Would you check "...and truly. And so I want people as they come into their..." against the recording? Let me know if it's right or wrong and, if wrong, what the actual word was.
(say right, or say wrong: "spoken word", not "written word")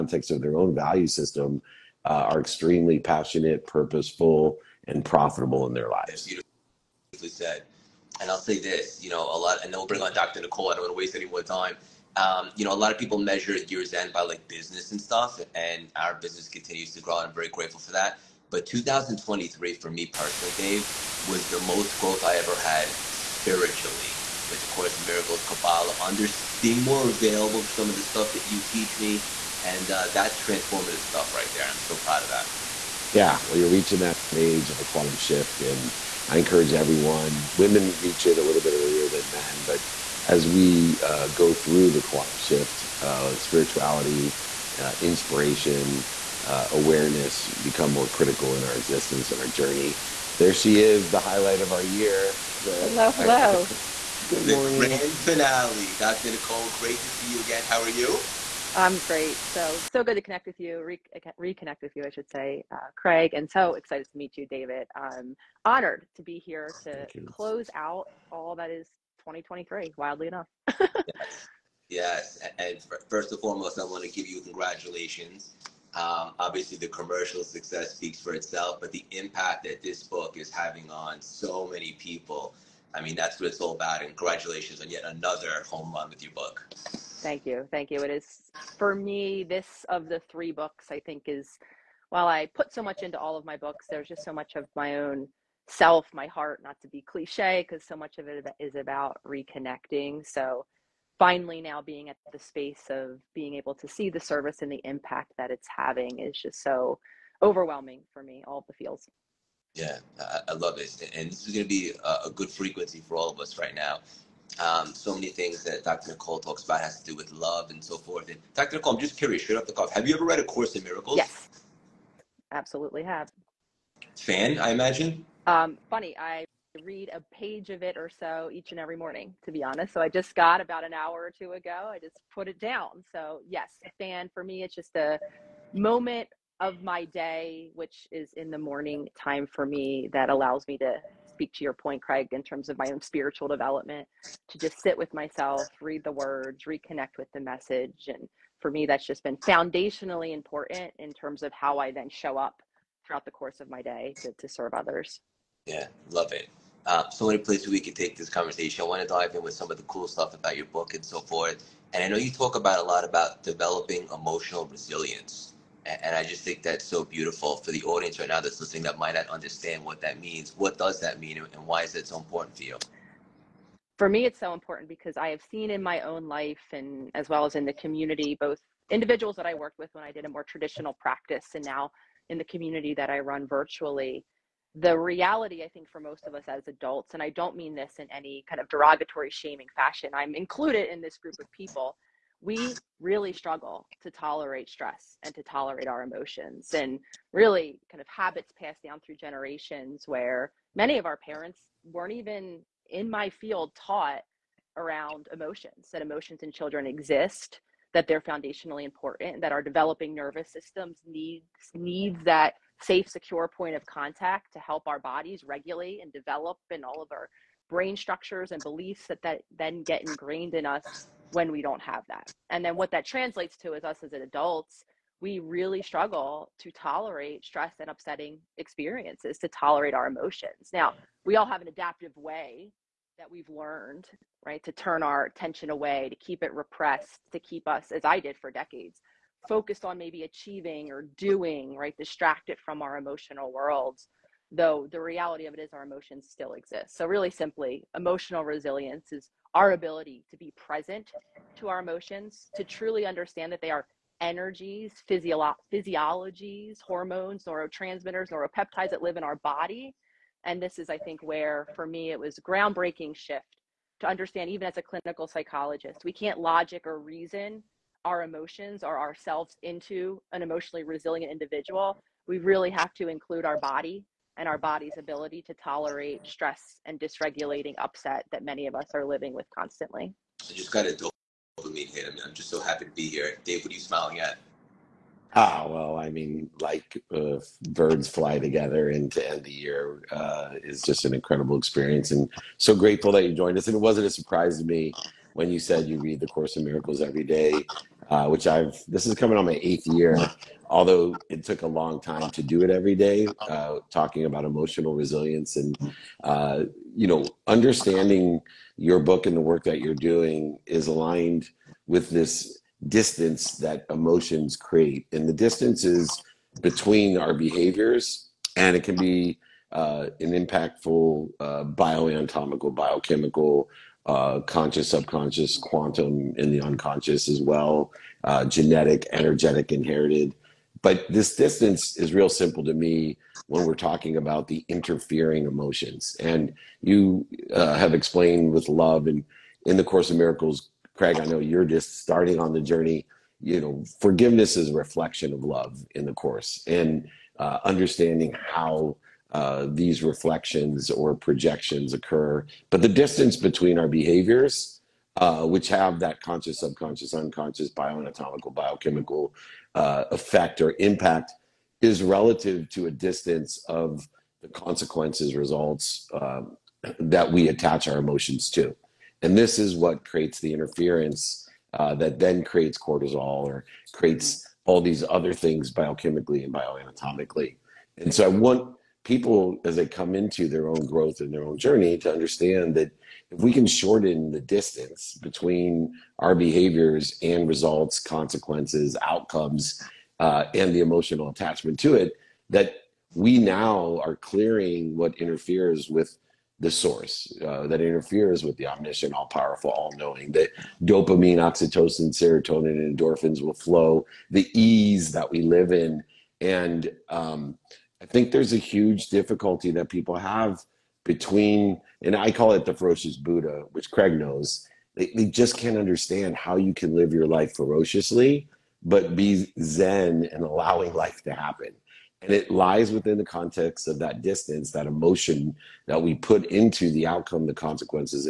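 wrong: "bioanatomically", not "truly".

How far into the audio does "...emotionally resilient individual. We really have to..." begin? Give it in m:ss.
4:30.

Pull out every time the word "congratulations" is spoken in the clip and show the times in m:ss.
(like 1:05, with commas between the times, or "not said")
1:14, 1:24.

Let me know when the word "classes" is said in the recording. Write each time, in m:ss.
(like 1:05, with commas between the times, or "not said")
not said.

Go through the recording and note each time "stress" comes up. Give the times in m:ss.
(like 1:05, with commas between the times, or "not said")
3:14, 3:47, 4:36.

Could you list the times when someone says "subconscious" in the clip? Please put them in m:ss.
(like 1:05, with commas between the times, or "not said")
5:24, 5:56.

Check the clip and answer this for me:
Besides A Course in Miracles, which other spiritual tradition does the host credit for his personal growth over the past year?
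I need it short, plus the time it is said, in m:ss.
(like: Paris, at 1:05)
Kabbalah, at 0:25.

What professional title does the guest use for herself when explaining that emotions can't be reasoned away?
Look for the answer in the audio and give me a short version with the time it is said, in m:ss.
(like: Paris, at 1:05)
Clinical psychologist, at 4:24.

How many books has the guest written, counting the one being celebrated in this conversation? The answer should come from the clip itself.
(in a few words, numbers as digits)
3.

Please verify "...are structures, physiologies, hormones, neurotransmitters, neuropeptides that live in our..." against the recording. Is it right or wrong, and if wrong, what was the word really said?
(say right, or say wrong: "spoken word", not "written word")
wrong: "energies", not "structures".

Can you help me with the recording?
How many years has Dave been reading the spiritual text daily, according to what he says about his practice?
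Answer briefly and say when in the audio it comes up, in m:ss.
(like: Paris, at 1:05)
8, at 4:59.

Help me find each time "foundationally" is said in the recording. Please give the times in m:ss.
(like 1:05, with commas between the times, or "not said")
2:29, 3:28.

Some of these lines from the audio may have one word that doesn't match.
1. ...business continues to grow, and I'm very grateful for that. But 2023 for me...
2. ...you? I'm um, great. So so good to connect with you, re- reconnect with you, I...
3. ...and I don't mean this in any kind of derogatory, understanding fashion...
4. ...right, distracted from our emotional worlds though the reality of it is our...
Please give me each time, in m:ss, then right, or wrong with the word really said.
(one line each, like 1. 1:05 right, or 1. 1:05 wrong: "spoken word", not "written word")
1. 0:16 right
2. 0:57 right
3. 3:07 wrong: "shaming", not "understanding"
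4. 4:01 right.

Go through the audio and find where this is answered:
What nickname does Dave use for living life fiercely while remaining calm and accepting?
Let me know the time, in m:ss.
6:52.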